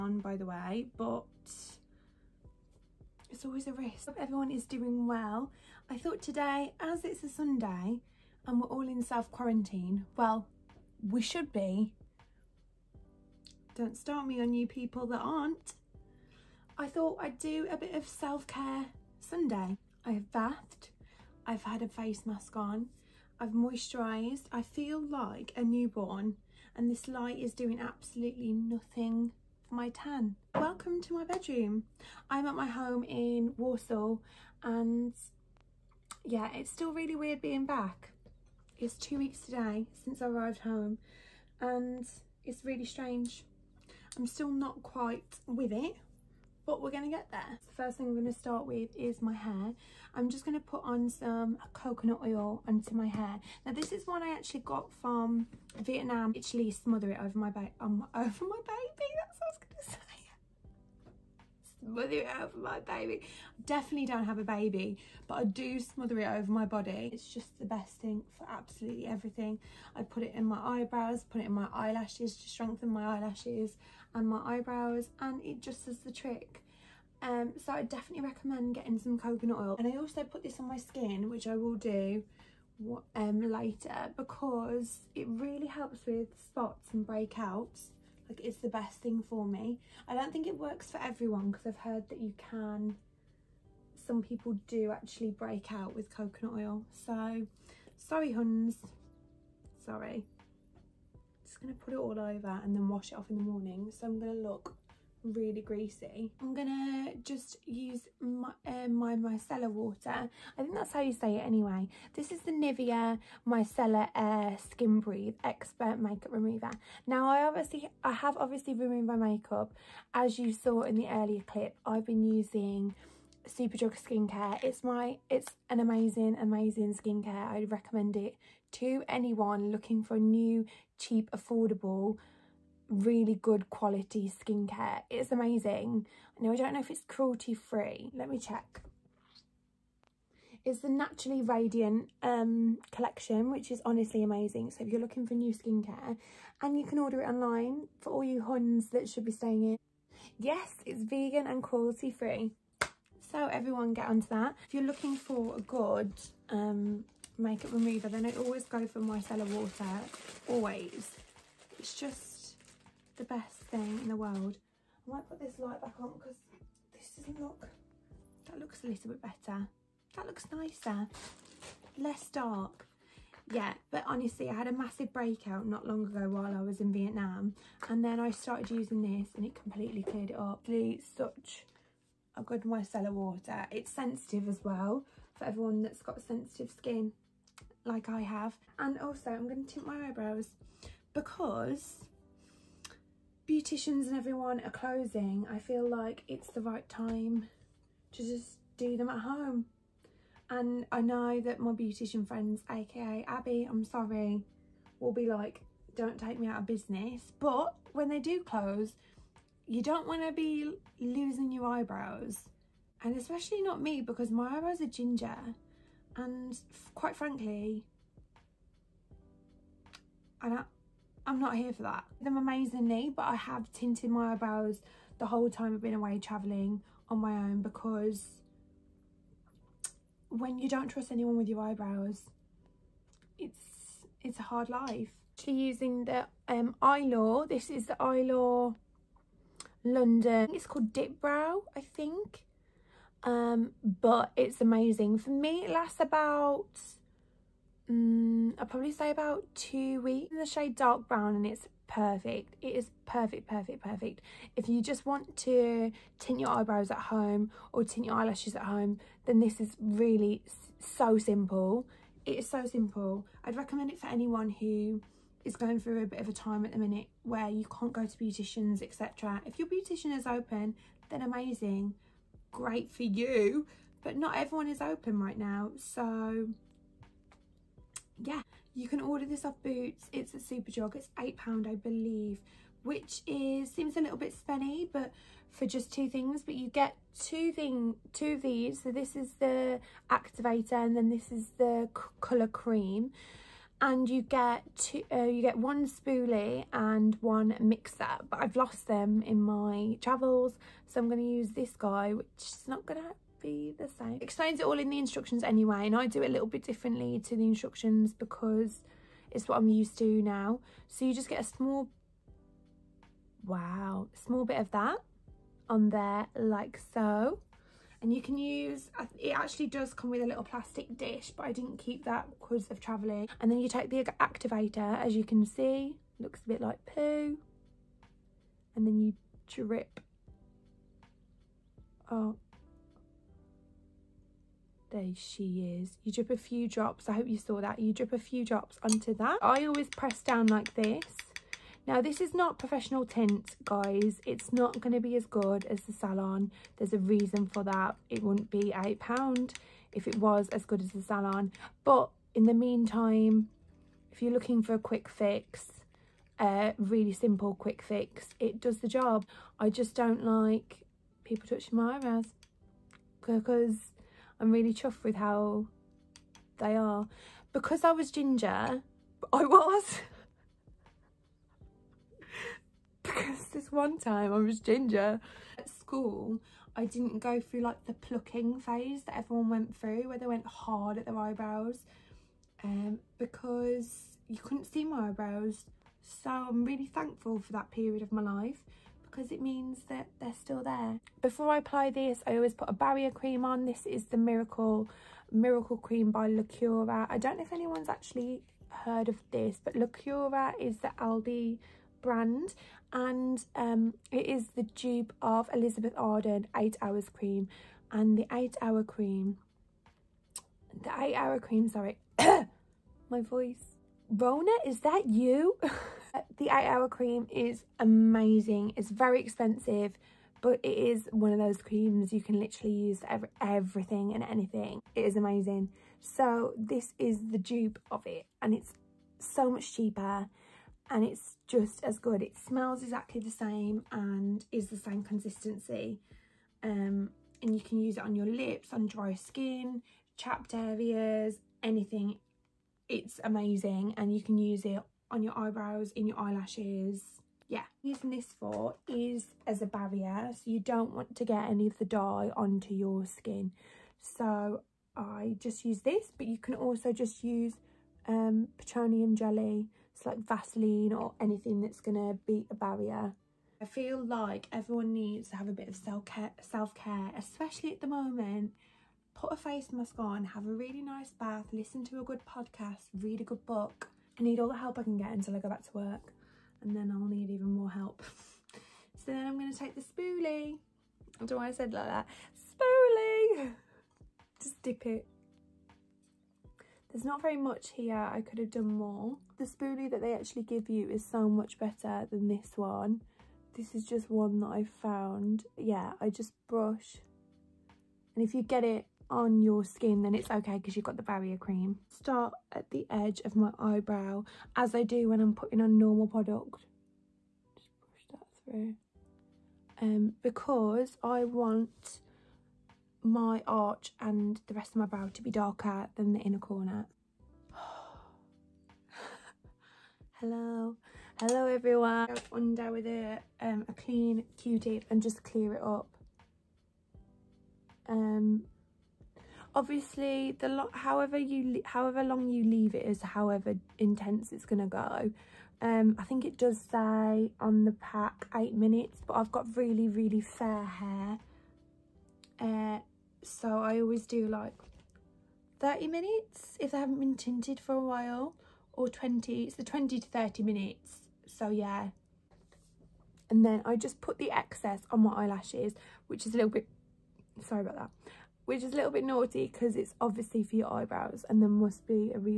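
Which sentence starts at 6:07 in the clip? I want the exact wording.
Because I was ginger, I was.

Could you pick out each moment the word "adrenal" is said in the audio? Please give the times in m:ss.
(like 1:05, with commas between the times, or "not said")
not said.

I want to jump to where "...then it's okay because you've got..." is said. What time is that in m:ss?
8:20.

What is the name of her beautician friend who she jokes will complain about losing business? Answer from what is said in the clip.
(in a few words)
Abby.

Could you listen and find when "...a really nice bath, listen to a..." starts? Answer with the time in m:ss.
7:50.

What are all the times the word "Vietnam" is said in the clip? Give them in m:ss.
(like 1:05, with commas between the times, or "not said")
0:55, 2:56.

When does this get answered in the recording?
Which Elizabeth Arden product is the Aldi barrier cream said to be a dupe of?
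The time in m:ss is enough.
6:46.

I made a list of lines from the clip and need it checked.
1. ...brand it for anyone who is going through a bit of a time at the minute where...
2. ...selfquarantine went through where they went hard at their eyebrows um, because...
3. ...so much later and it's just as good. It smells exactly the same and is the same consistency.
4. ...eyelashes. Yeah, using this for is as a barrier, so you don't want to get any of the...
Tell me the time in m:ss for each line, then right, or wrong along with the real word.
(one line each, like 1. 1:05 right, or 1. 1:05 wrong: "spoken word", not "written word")
1. 4:23 wrong: "recommend", not "brand"
2. 6:19 wrong: "everyone", not "selfquarantine"
3. 7:09 wrong: "cheaper", not "later"
4. 7:26 right.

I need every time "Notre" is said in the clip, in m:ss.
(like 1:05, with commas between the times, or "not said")
not said.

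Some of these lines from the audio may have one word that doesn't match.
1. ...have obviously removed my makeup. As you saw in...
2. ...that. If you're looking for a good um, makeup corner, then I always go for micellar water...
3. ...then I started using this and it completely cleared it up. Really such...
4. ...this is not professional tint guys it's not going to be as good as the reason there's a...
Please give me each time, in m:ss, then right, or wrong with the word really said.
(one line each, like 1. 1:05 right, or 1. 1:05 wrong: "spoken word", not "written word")
1. 1:58 right
2. 2:34 wrong: "remover", not "corner"
3. 2:58 right
4. 5:42 wrong: "salon", not "reason".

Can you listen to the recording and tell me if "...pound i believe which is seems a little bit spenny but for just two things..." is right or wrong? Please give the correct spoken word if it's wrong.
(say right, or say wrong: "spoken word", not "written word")
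right.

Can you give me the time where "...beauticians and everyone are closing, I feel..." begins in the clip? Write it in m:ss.
3:13.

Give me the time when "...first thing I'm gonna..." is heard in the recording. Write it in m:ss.
0:47.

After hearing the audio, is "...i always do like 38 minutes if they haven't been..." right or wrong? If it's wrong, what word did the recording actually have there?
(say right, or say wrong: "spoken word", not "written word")
wrong: "30", not "38".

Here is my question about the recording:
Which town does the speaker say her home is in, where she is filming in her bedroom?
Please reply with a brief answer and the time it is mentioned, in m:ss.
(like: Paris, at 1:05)
Walsall, at 0:33.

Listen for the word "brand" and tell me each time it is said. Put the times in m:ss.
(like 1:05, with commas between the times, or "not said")
6:42.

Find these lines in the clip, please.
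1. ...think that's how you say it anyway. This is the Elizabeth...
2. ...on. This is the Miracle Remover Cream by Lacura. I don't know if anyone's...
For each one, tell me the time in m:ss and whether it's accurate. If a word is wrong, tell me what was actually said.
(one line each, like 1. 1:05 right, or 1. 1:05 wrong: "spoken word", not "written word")
1. 1:50 wrong: "Nivea", not "Elizabeth"
2. 6:33 wrong: "Miracle", not "Remover".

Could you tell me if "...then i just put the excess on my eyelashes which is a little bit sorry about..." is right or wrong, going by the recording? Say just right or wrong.
right.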